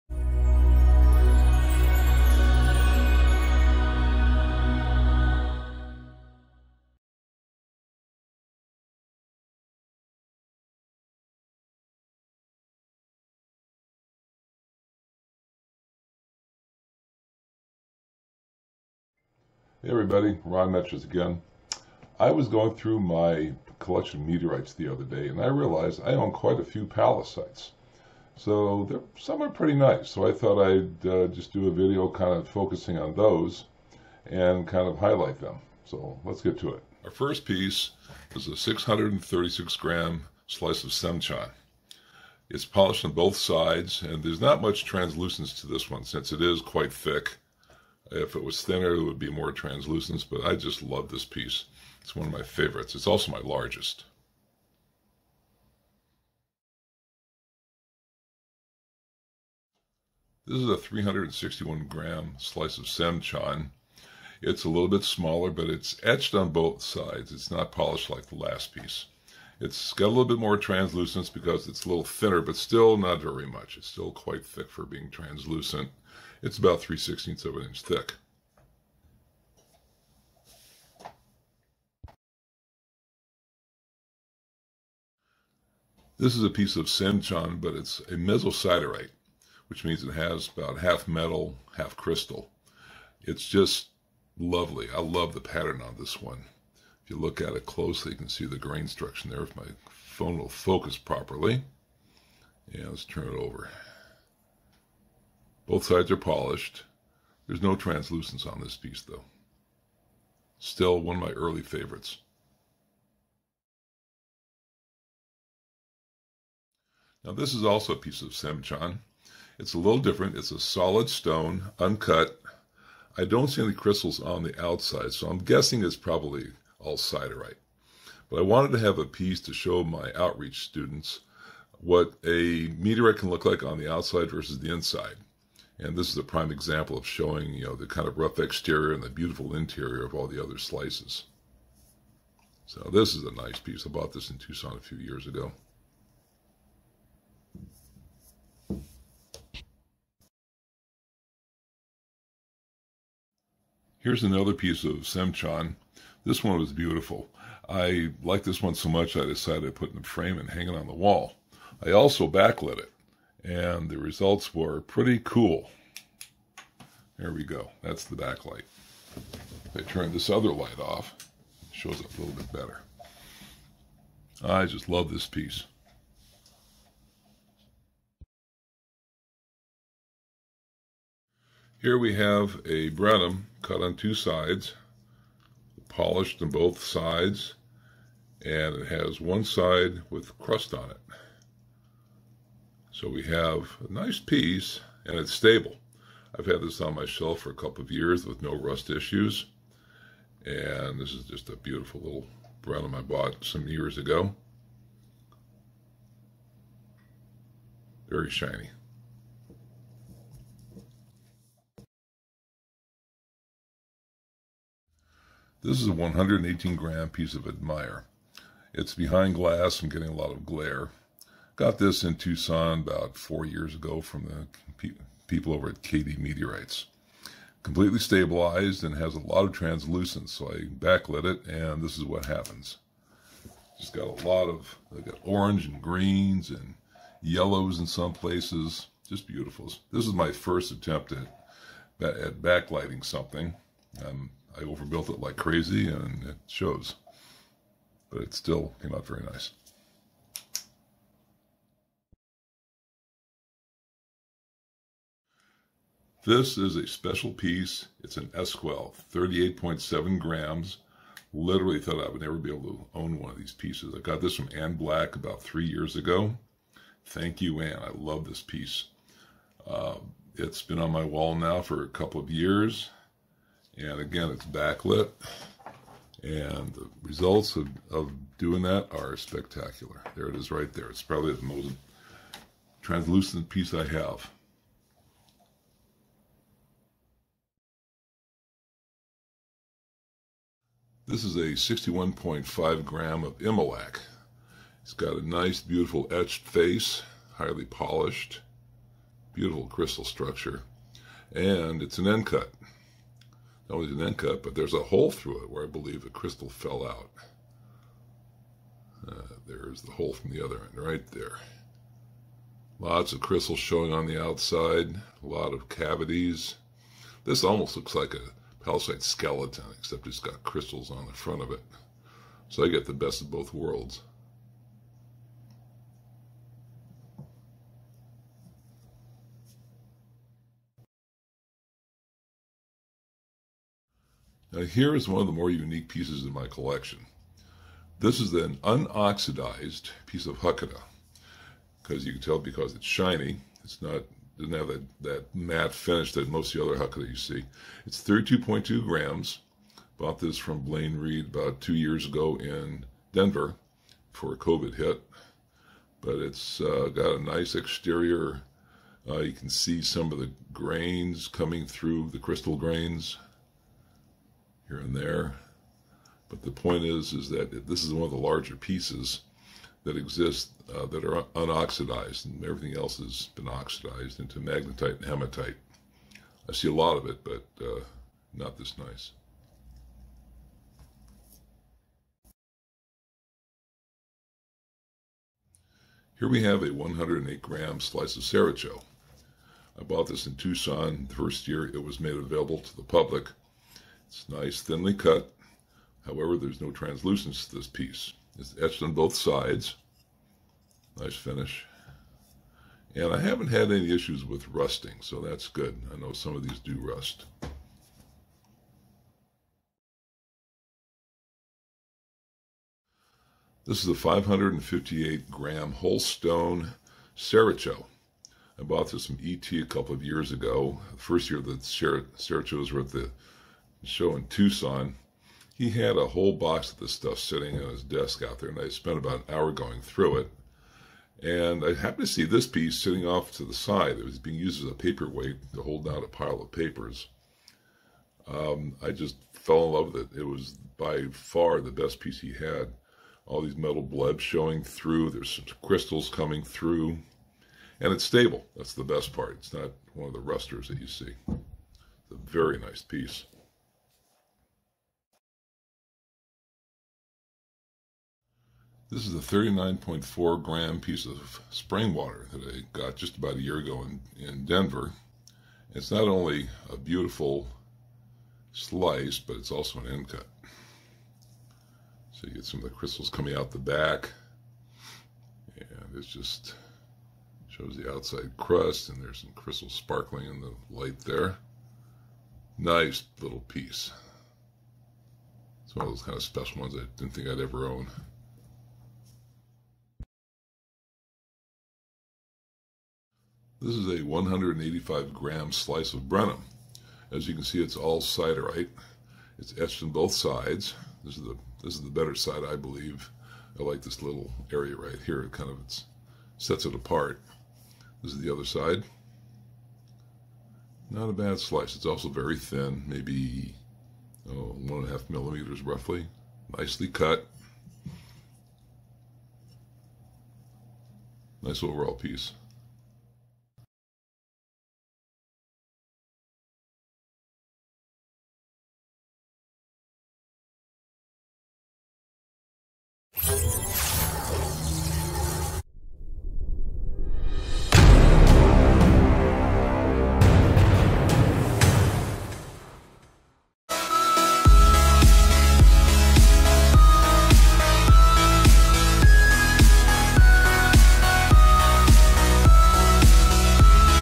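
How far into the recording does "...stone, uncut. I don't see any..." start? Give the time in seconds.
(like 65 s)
121 s.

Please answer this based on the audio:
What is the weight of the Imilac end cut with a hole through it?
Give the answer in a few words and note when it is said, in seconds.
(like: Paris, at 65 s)
61.5 grams, at 291 s.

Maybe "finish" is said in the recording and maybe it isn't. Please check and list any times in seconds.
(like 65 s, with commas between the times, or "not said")
345 s, 401 s.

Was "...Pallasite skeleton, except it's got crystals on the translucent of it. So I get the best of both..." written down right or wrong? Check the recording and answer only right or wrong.
wrong.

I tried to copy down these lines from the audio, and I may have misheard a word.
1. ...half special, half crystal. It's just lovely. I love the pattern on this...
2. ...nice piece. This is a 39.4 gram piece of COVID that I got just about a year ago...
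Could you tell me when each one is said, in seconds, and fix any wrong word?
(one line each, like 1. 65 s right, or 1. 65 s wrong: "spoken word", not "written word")
1. 90 s wrong: "metal", not "special"
2. 452 s wrong: "Springwater", not "COVID".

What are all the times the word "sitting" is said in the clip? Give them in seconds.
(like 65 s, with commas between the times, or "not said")
427 s, 432 s.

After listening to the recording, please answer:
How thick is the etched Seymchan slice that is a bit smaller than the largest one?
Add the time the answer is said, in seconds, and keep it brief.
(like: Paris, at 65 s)
3/16 of an inch, at 76 s.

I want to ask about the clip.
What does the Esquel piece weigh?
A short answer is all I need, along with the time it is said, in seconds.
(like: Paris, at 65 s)
38.7 grams, at 259 s.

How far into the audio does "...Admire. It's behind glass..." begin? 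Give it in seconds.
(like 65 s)
217 s.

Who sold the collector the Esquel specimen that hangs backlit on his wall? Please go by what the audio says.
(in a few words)
Anne Black.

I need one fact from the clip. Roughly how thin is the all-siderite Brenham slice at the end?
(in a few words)
1.5 millimeters.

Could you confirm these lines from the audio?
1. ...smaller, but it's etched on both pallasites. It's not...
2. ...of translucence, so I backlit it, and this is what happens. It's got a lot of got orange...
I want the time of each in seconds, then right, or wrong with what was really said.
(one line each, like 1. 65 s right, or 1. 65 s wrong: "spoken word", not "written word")
1. 65 s wrong: "sides", not "pallasites"
2. 229 s right.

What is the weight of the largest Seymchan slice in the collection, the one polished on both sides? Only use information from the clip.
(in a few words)
636 grams.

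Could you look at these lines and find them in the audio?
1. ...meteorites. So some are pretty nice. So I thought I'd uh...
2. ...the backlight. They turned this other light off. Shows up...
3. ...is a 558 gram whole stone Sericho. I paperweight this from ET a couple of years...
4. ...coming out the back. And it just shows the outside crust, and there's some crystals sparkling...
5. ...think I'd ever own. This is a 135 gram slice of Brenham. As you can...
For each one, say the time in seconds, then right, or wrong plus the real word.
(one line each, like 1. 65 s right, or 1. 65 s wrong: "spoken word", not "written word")
1. 26 s wrong: "pallasites", not "meteorites"
2. 168 s right
3. 413 s wrong: "bought", not "paperweight"
4. 473 s right
5. 487 s wrong: "185", not "135".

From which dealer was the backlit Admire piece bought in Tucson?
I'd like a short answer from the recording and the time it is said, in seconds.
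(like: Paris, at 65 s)
KD Meteorites, at 225 s.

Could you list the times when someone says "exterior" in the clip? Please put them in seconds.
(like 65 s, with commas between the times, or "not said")
138 s, 357 s.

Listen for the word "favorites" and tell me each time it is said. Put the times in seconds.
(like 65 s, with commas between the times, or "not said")
52 s, 111 s.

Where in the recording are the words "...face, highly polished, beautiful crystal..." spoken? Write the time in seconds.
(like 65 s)
296 s.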